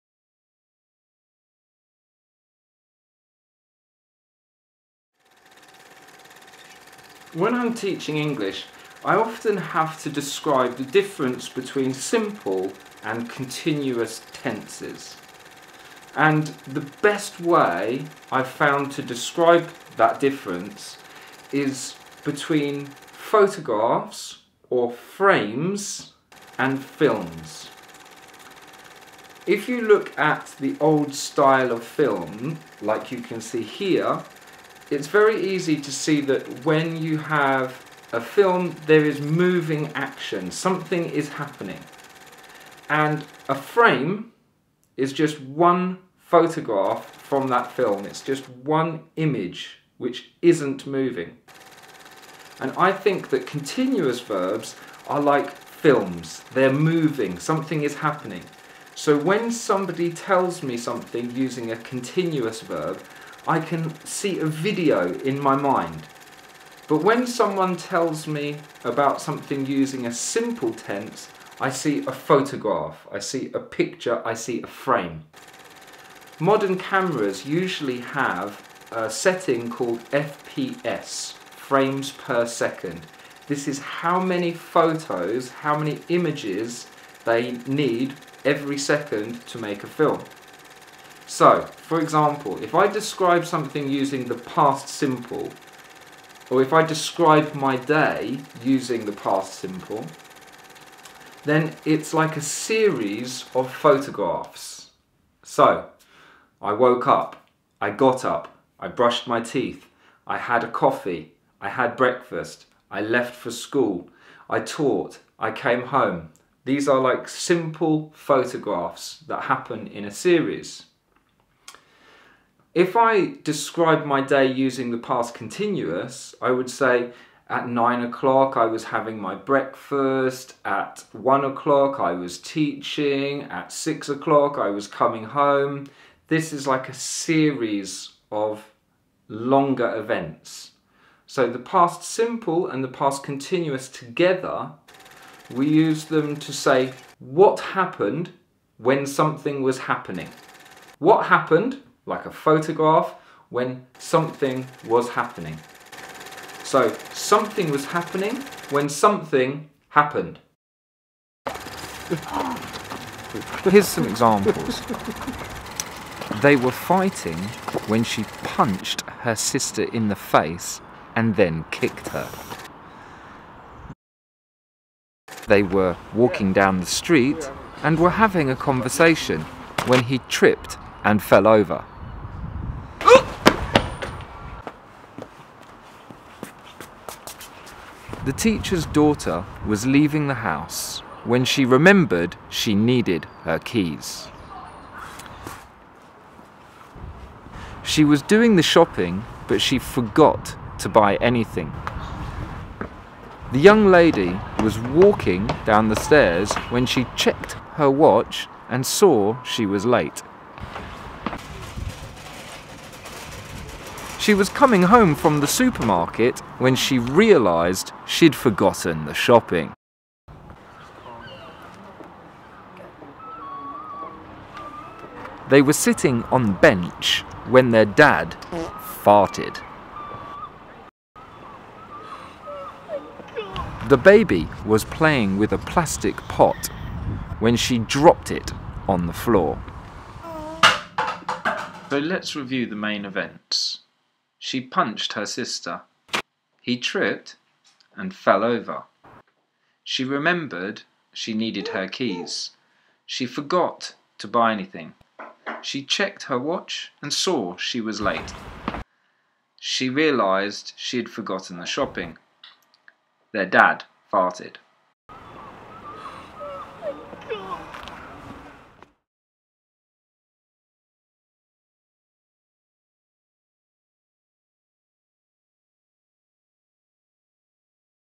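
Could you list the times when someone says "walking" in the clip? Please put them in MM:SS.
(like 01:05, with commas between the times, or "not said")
02:56, 03:24.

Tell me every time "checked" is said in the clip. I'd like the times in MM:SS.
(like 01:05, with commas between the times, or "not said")
03:27, 04:15.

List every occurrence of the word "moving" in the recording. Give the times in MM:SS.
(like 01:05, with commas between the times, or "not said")
00:39, 00:50, 00:56.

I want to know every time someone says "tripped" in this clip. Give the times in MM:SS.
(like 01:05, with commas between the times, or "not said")
03:00, 04:06.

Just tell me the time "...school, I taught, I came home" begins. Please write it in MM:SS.
01:53.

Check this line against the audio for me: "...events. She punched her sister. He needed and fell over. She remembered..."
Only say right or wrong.
wrong.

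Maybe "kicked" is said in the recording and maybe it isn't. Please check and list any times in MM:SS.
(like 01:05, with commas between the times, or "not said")
02:51.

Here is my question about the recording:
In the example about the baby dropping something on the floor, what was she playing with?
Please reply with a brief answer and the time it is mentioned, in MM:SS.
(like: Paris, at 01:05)
A plastic pot, at 03:55.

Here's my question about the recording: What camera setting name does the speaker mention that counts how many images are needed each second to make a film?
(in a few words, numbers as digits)
FPS.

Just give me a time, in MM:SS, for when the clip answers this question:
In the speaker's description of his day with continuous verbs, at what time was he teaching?
02:11.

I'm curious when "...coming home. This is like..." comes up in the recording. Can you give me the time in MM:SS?
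02:14.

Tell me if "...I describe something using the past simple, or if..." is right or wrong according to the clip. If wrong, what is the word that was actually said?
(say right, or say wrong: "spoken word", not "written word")
right.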